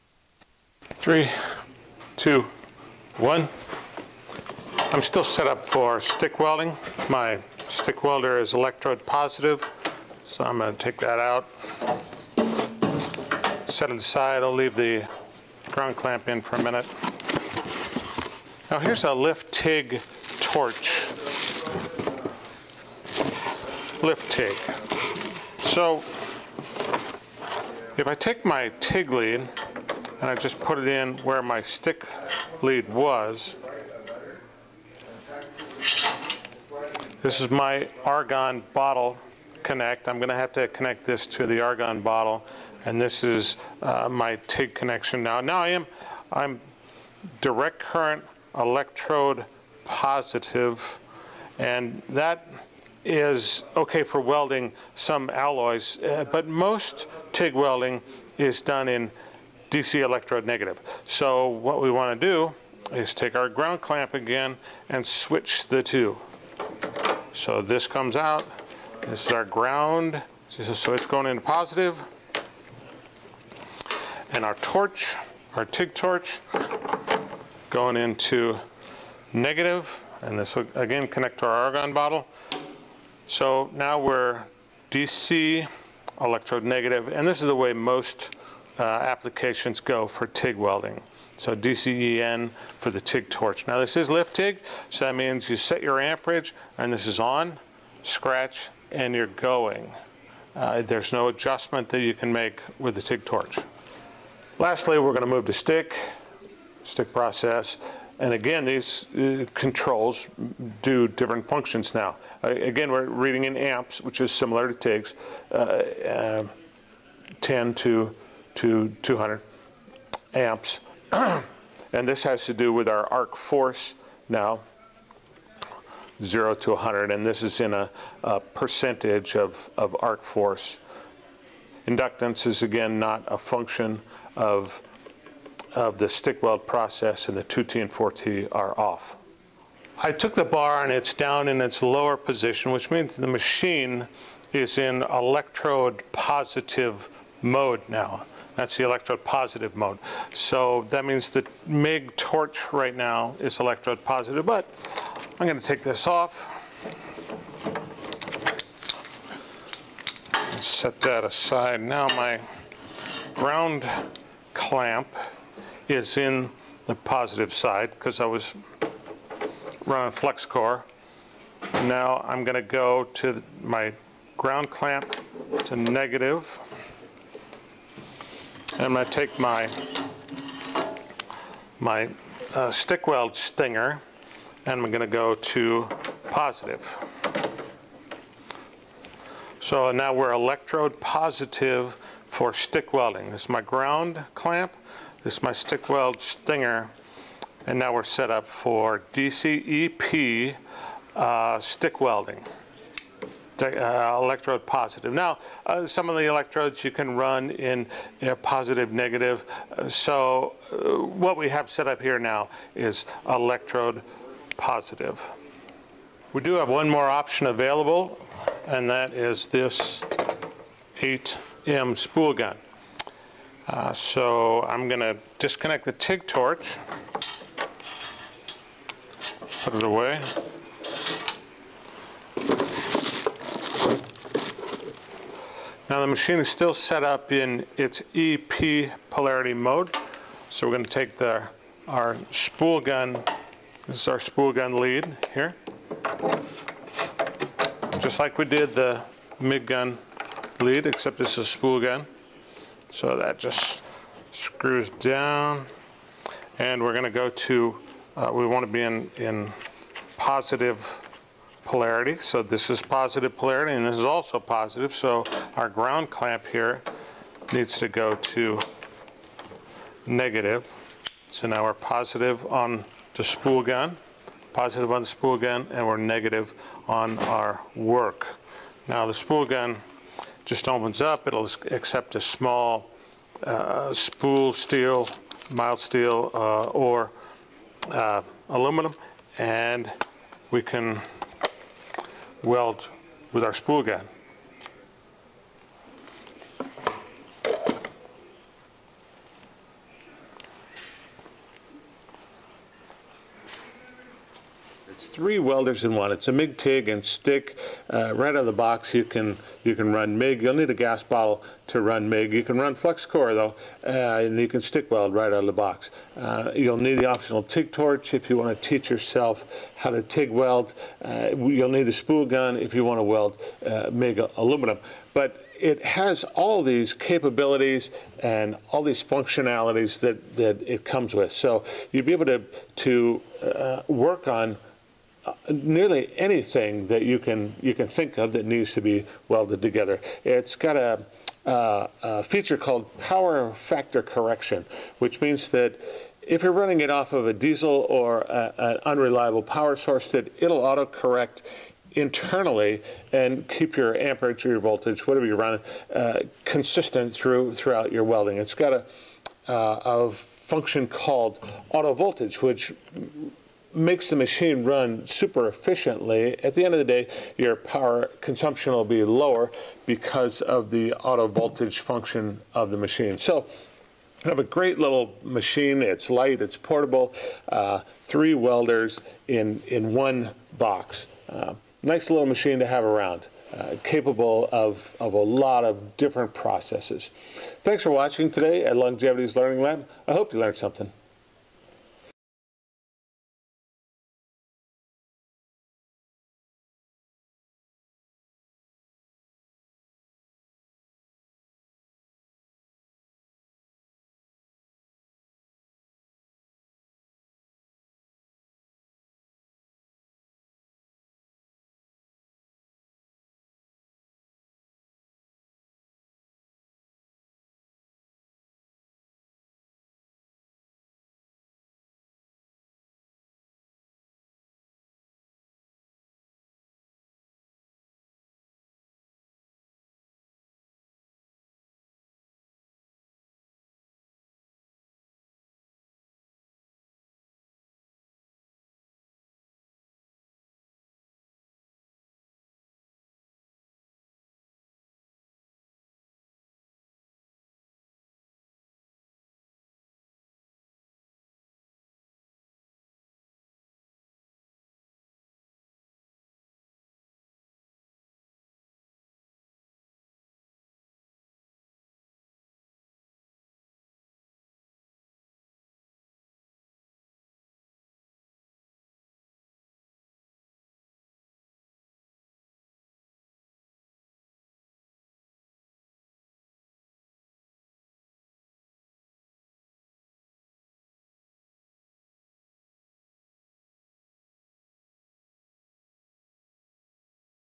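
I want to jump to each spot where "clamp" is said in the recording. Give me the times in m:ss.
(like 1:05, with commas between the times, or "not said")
0:15, 1:03, 2:44, 2:54, 3:14, 4:26.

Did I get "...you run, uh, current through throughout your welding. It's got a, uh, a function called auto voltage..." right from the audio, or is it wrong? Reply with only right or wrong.
wrong.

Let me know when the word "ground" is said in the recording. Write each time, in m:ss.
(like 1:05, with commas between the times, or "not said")
0:15, 1:03, 1:09, 2:54, 3:13, 4:25.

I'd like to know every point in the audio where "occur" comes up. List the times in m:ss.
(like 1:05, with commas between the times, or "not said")
not said.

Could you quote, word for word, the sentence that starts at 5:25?
But it has all these capabilities and all these functionalities that, that it comes with.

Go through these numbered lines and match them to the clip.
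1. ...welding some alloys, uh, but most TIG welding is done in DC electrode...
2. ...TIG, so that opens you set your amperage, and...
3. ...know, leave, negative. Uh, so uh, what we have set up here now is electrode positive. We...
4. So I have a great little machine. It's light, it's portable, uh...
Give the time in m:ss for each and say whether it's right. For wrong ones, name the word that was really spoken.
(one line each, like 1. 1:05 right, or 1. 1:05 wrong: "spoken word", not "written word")
1. 0:54 right
2. 1:34 wrong: "means", not "opens"
3. 3:28 wrong: "positive", not "leave"
4. 6:13 right.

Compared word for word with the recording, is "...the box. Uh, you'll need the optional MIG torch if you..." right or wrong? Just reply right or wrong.
wrong.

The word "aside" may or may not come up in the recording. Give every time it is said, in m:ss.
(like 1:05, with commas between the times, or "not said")
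0:13, 2:41.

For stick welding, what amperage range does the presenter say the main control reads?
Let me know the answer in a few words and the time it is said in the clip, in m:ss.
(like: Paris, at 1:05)
10 to 200 amps, at 1:57.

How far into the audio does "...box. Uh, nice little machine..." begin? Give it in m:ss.
6:20.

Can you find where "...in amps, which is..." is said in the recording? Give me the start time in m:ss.
1:53.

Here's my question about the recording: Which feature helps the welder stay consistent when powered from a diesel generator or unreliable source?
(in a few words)
Power factor correction.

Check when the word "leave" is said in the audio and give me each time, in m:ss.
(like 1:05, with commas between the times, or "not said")
0:14.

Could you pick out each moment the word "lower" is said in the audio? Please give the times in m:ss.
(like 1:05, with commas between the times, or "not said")
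2:21, 6:09.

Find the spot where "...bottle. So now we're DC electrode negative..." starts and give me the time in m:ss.
1:21.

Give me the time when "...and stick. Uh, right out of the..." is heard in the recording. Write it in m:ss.
5:06.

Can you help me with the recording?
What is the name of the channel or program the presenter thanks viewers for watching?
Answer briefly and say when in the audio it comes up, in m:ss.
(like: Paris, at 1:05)
Longevity's Learning Lab, at 6:28.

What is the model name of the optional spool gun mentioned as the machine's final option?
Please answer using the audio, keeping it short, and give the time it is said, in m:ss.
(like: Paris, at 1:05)
8 M, at 3:40.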